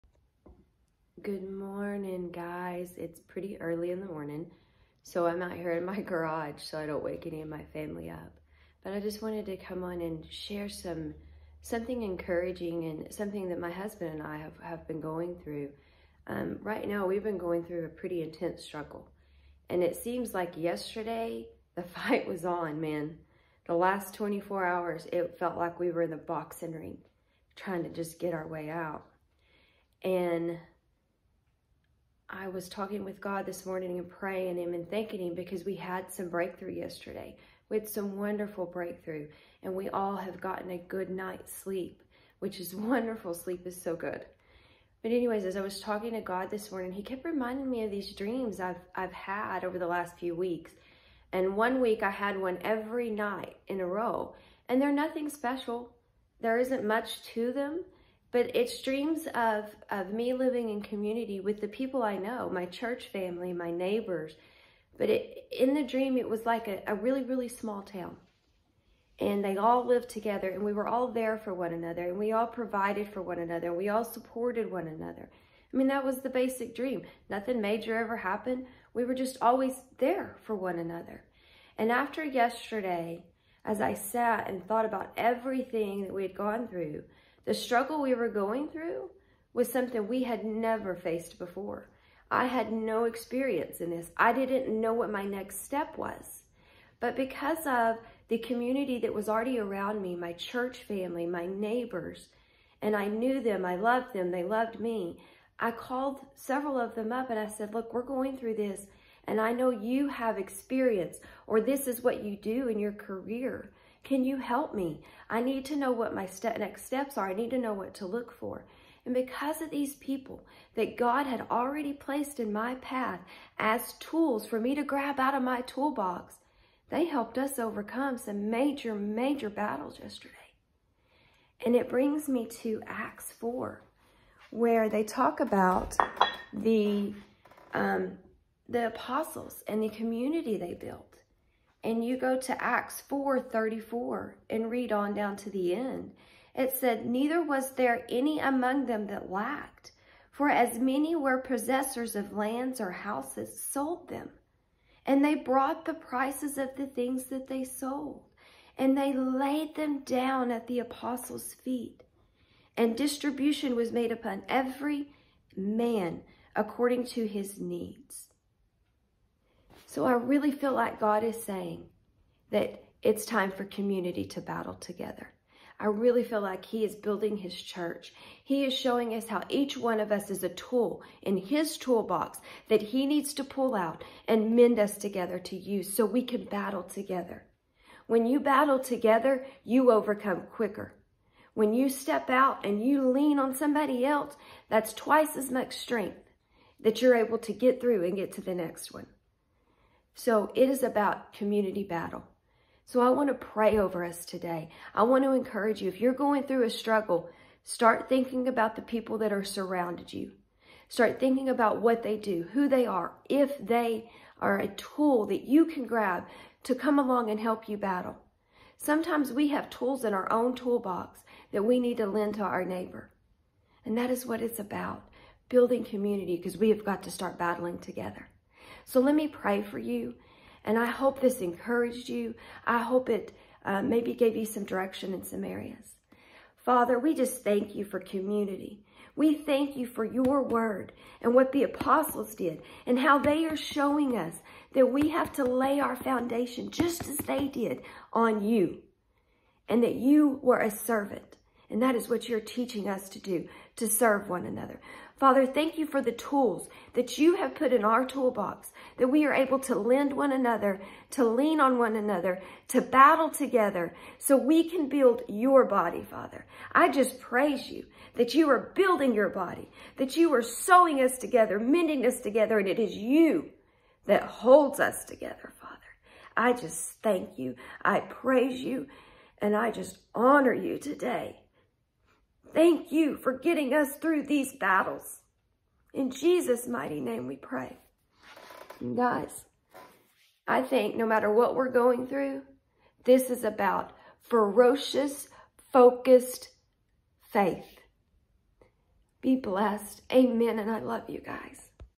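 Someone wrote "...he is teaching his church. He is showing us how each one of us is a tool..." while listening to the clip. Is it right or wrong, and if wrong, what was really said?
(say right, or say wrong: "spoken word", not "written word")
wrong: "building", not "teaching".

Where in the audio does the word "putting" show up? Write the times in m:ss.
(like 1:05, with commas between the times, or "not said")
not said.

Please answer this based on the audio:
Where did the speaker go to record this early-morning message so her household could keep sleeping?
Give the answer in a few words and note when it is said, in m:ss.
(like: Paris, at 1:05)
garage, at 0:06.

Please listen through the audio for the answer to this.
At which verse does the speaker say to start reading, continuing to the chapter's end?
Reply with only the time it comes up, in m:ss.
2:22.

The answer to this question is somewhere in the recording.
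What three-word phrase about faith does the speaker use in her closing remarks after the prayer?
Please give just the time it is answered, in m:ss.
4:54.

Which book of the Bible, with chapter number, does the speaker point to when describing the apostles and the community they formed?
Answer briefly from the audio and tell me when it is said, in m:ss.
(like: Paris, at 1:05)
Acts 4, at 2:12.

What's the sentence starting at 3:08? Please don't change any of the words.
When you battle together, you overcome quicker.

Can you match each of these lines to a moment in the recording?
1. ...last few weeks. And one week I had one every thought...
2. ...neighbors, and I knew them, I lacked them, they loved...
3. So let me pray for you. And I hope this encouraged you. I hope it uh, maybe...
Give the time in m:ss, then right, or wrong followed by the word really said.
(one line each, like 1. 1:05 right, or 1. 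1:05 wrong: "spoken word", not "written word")
1. 0:49 wrong: "night", not "thought"
2. 1:41 wrong: "loved", not "lacked"
3. 3:48 right.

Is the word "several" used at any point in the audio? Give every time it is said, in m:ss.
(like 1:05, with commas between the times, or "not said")
1:46.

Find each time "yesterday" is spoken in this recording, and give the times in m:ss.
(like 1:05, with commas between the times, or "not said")
0:20, 0:36, 1:22, 2:10.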